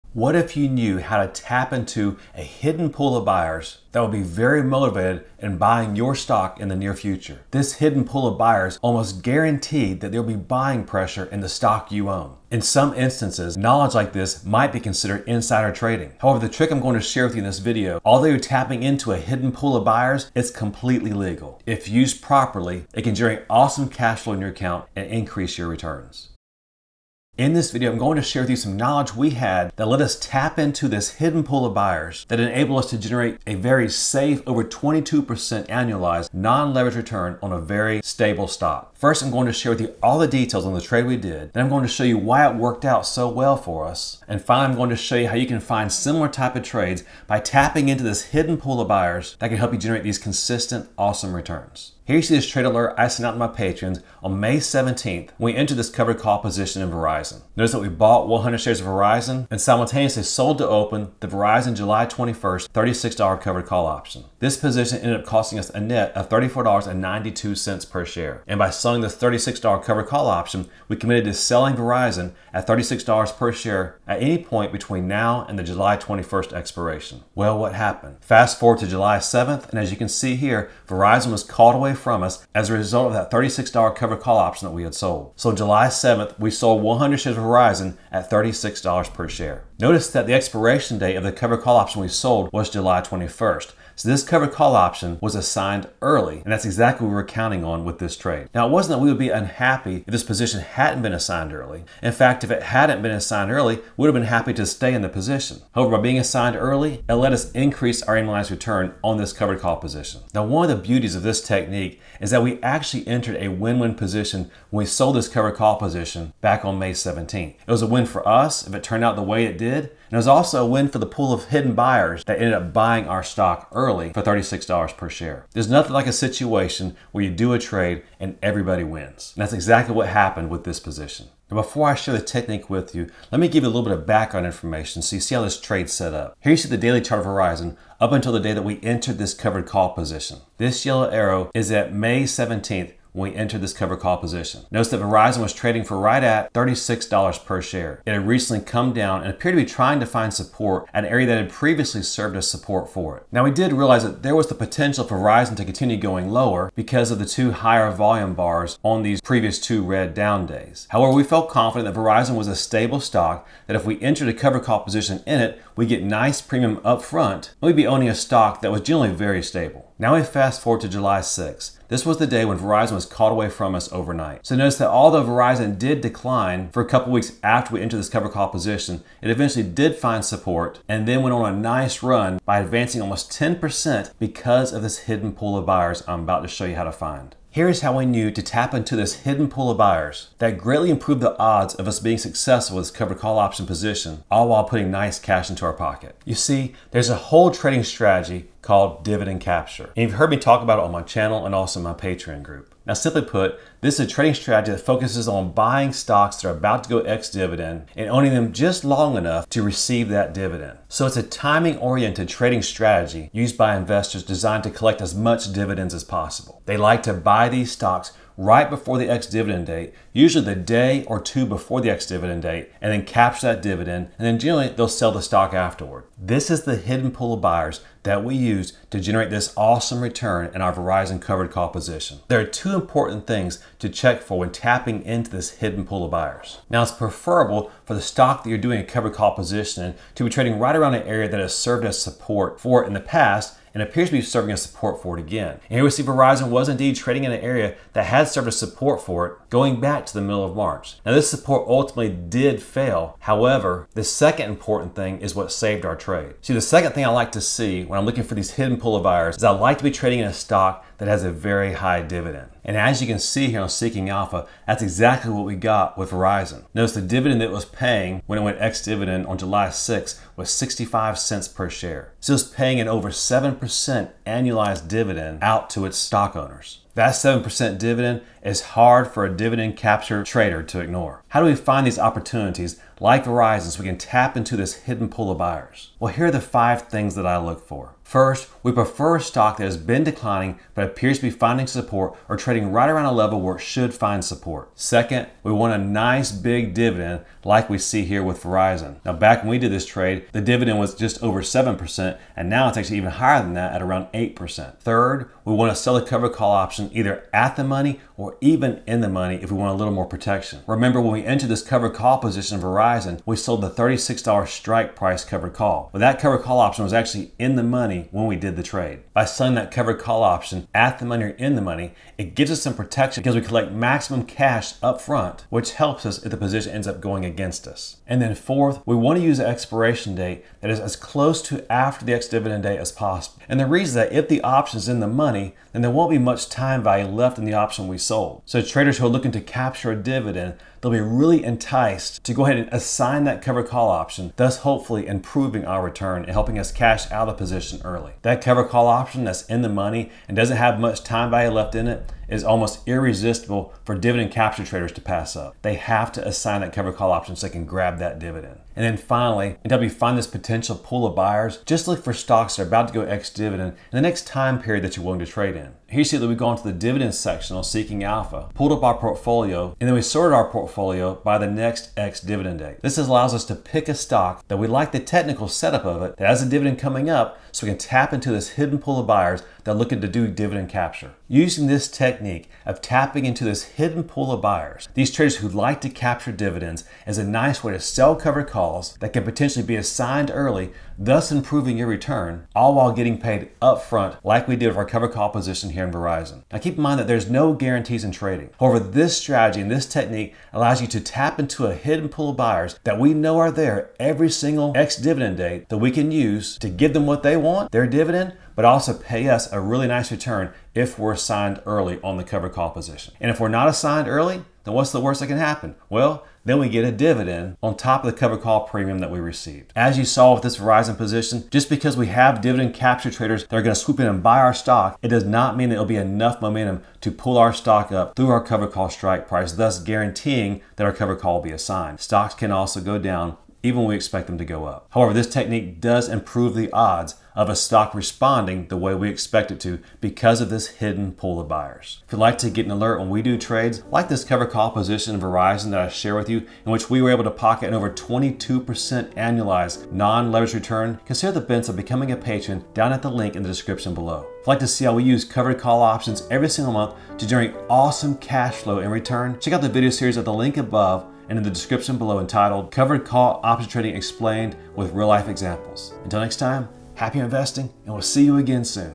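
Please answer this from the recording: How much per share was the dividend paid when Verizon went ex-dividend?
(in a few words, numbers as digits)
65 cents.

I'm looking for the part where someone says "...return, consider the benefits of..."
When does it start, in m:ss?
7:30.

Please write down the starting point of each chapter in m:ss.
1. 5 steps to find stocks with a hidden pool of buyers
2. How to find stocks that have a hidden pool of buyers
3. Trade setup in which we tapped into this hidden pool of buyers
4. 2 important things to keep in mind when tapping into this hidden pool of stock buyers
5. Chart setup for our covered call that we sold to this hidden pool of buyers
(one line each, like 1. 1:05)
1. 4:41
2. 3:07
3. 0:38
4. 3:52
5. 2:11.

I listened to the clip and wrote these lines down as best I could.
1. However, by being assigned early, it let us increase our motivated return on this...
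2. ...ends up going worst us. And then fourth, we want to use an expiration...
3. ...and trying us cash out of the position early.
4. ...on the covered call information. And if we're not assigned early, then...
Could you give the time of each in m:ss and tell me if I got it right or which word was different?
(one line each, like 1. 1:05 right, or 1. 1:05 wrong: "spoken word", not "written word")
1. 1:45 wrong: "annualized", not "motivated"
2. 5:26 wrong: "against", not "worst"
3. 5:46 wrong: "helping", not "trying"
4. 6:52 wrong: "position", not "information".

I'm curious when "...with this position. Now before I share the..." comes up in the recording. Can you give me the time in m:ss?
2:10.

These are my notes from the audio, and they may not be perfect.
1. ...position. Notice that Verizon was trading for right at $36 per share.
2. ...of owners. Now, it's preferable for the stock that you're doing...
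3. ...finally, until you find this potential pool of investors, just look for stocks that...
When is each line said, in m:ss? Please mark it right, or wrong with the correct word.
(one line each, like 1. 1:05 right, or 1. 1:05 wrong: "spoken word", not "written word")
1. 2:24 right
2. 3:56 wrong: "buyers", not "owners"
3. 5:58 wrong: "buyers", not "investors".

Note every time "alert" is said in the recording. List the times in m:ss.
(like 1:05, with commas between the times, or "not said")
0:52, 7:22.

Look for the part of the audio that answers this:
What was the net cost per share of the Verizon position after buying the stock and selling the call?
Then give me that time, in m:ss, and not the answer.
1:06.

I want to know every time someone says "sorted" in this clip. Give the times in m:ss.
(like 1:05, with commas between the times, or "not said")
6:10.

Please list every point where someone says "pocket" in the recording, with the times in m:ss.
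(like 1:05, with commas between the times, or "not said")
3:15, 7:27.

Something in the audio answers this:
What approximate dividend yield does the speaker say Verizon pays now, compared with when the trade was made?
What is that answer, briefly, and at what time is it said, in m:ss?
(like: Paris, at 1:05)
8%, at 5:03.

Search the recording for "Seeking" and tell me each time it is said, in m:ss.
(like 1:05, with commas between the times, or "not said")
4:23, 6:07.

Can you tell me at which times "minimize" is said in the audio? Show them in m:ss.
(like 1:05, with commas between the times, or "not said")
not said.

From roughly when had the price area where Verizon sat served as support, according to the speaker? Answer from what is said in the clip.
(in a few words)
middle of March.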